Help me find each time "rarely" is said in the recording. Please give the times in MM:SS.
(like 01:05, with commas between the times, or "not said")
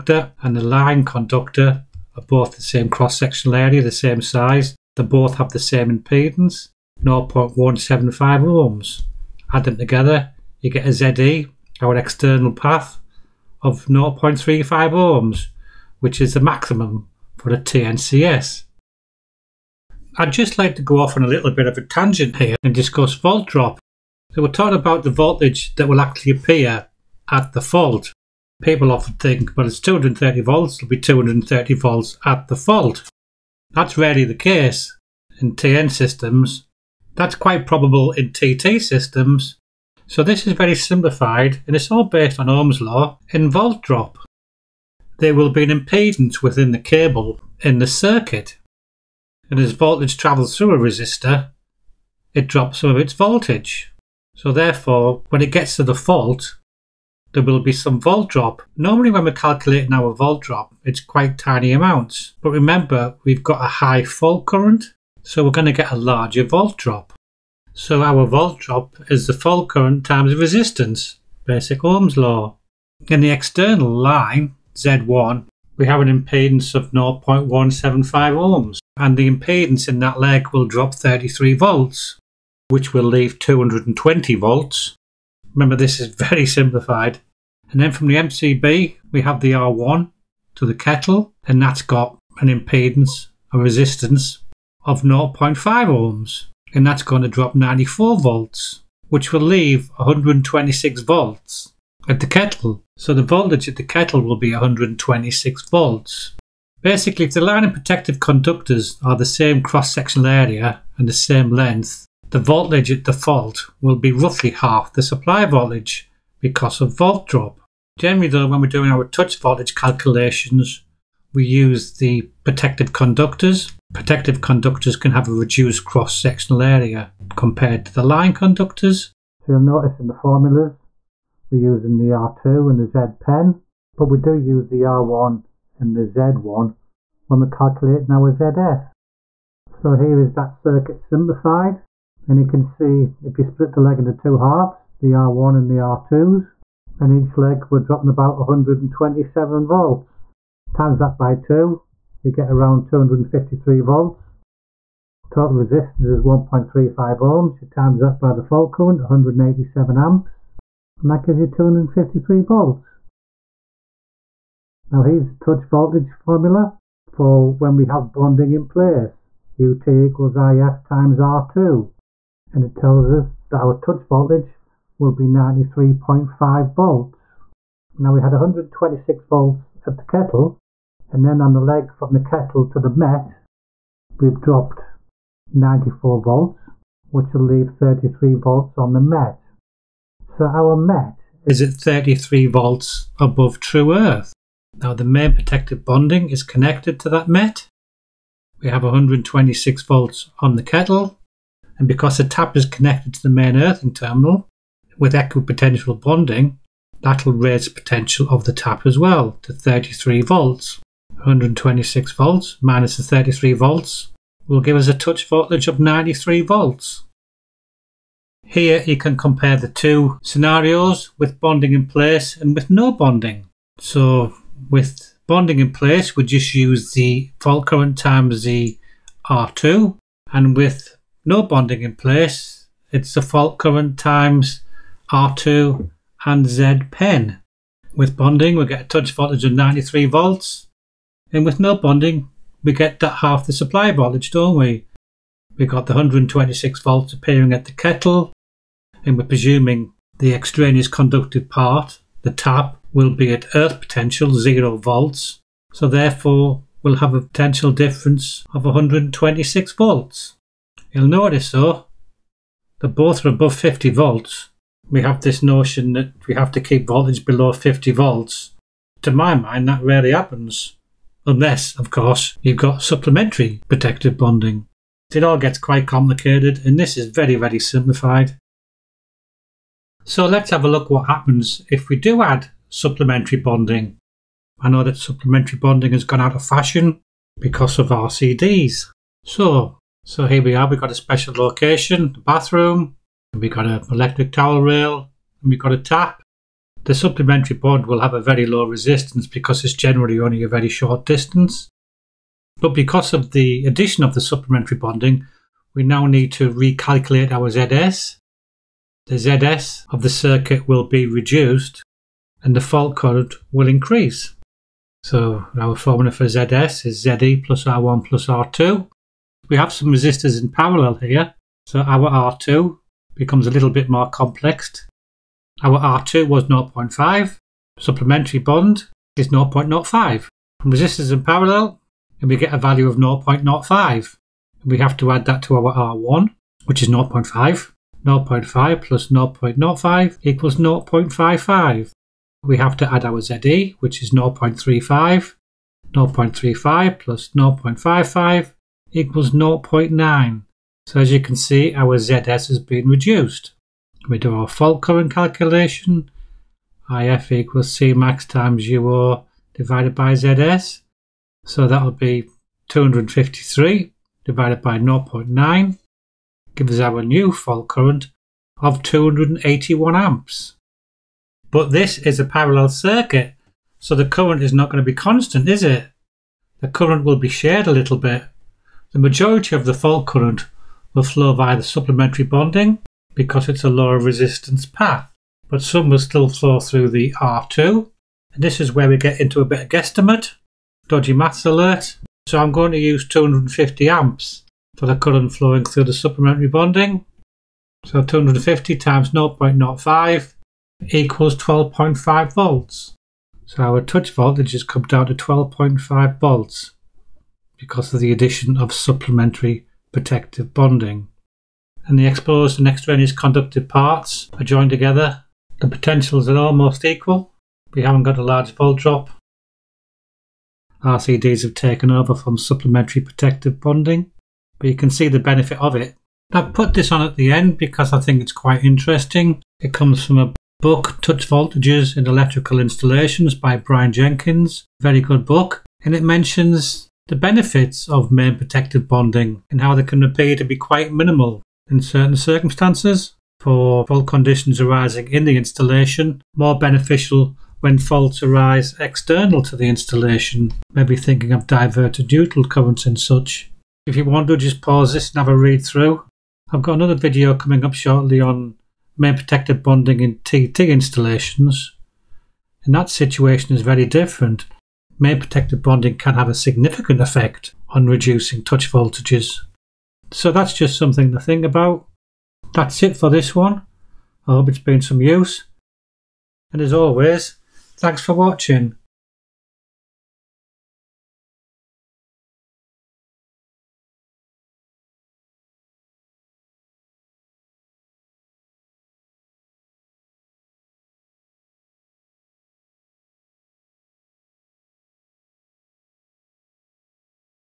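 00:33, 04:29.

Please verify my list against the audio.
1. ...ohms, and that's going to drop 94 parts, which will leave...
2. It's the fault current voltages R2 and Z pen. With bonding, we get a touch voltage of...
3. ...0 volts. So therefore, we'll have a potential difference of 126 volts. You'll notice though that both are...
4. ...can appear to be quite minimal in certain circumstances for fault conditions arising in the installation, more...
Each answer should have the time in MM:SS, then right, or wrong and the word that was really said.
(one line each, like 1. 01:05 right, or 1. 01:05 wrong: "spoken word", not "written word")
1. 01:35 wrong: "volts", not "parts"
2. 03:52 wrong: "times", not "voltages"
3. 04:14 right
4. 07:19 right.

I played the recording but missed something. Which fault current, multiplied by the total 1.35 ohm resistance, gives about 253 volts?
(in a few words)
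187 amps.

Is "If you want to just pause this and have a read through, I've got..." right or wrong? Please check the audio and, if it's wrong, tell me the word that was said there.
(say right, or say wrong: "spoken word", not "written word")
right.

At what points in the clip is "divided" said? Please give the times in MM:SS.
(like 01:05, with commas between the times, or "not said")
05:59, 06:04.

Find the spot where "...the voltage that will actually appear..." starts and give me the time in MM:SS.
00:25.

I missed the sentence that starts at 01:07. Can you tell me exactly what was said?
So our volt drop is the fault current times the resistance, basic Ohm's law.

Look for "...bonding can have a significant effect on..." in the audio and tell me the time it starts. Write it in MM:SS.
07:45.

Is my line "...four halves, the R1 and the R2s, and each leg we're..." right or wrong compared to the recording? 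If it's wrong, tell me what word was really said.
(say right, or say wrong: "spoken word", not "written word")
wrong: "two", not "four".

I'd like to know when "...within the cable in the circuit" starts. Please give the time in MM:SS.
00:46.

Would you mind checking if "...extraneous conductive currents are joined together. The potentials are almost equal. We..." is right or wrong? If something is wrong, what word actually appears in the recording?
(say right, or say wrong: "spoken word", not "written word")
wrong: "parts", not "currents".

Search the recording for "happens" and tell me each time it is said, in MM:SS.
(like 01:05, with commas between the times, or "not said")
04:30, 04:41.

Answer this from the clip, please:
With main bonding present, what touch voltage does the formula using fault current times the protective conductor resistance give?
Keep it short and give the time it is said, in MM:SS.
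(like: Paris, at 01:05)
93.5 volts, at 02:55.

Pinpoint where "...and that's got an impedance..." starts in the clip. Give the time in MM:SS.
01:31.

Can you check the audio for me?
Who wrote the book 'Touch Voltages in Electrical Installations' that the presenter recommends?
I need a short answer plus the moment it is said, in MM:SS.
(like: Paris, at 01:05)
Brian Jenkins, at 07:13.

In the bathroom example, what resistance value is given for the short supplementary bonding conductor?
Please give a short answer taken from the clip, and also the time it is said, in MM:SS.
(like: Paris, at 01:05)
0.05 ohms, at 05:27.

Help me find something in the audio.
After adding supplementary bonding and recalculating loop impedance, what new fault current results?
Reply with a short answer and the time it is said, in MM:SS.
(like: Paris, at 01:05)
281 amps, at 06:08.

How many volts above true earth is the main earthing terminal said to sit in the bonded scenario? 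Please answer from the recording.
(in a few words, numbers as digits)
33 volts.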